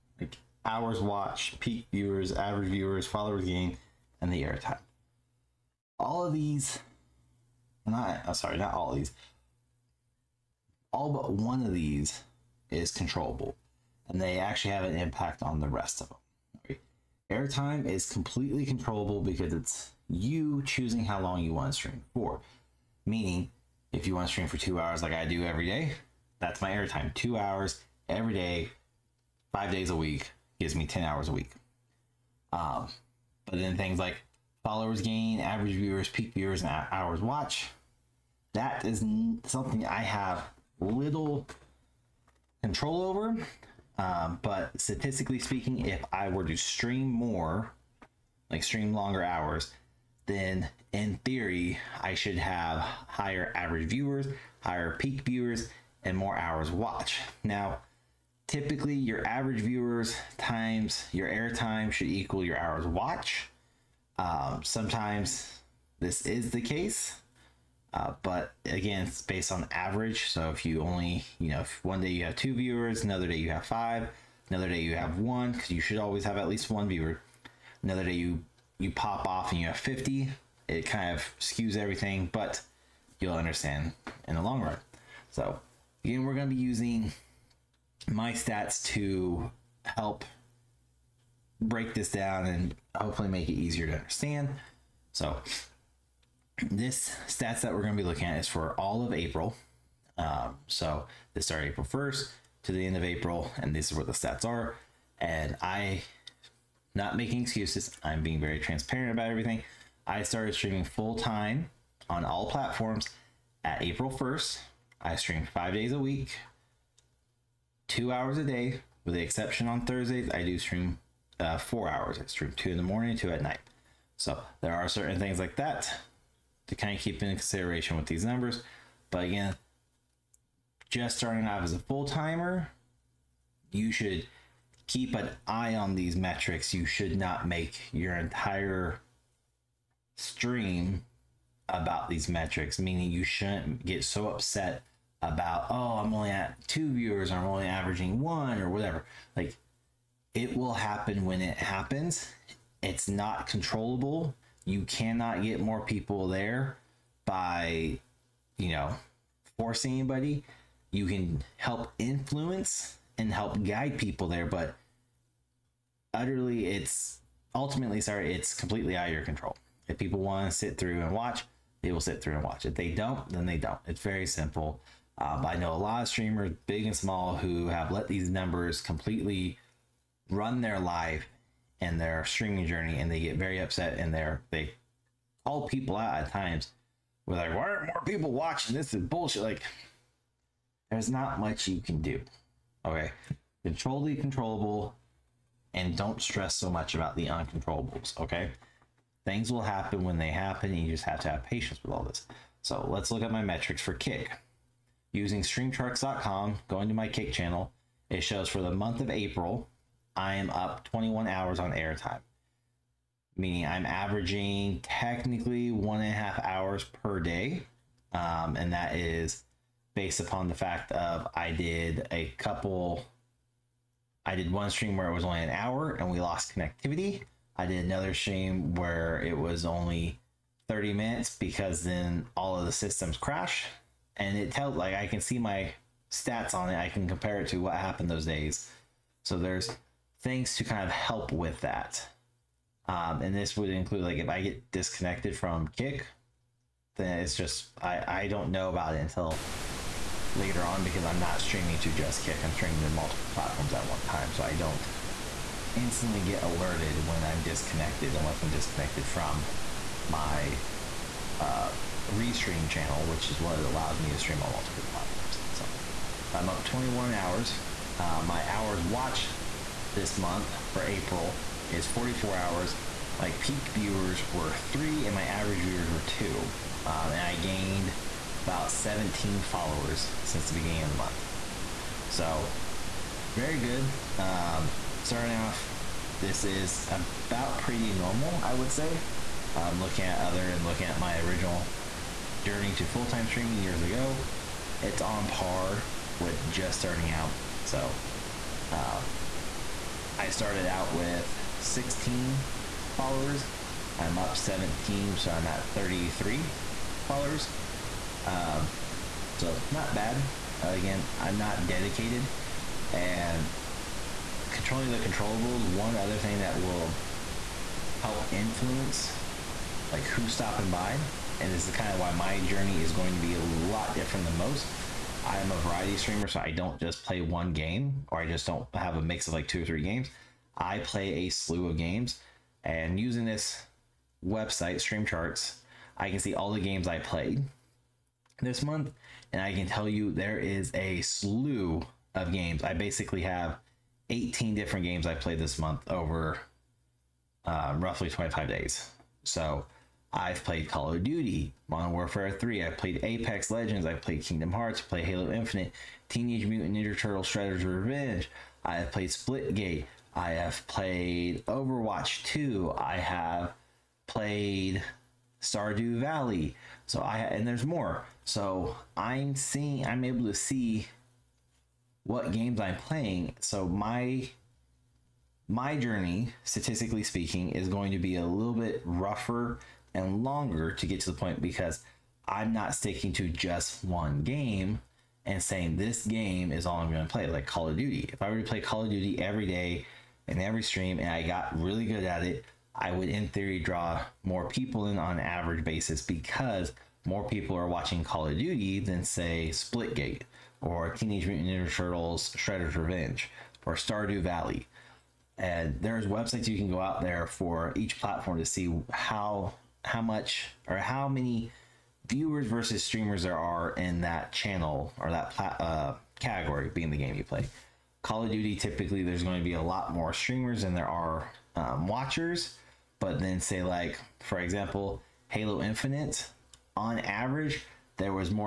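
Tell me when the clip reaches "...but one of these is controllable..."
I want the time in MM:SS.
00:11.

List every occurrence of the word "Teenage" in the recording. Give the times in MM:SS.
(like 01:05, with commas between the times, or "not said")
05:56, 06:40.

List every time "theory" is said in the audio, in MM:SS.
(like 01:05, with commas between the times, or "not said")
00:51, 06:33.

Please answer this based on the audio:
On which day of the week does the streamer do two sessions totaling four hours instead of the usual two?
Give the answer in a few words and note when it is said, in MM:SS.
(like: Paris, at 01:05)
Thursdays, at 01:59.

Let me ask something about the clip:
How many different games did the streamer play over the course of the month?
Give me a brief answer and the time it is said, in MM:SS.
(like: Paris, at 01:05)
18, at 05:44.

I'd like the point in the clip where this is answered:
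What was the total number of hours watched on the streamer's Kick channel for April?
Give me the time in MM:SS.
04:31.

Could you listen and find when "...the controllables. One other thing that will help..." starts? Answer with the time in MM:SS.
05:14.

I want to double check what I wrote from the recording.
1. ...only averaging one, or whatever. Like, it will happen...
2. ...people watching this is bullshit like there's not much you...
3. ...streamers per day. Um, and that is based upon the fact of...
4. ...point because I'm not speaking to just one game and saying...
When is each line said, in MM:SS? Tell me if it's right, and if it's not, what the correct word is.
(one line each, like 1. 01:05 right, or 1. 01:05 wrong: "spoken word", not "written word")
1. 02:27 right
2. 03:08 right
3. 03:36 wrong: "hours", not "streamers"
4. 06:21 wrong: "sticking", not "speaking".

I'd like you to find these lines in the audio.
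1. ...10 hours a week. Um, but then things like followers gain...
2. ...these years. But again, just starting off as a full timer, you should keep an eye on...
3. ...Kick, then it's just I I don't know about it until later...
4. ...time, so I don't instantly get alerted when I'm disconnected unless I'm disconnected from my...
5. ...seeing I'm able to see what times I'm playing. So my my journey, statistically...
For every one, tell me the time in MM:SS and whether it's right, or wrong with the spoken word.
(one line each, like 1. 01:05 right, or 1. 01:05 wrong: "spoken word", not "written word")
1. 00:30 right
2. 02:08 wrong: "numbers", not "years"
3. 04:05 right
4. 04:14 right
5. 06:09 wrong: "games", not "times".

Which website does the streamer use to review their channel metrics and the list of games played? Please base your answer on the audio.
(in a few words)
streamcharts.com.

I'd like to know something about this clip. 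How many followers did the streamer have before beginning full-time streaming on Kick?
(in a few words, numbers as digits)
16.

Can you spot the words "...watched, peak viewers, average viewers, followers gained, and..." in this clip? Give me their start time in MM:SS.
00:00.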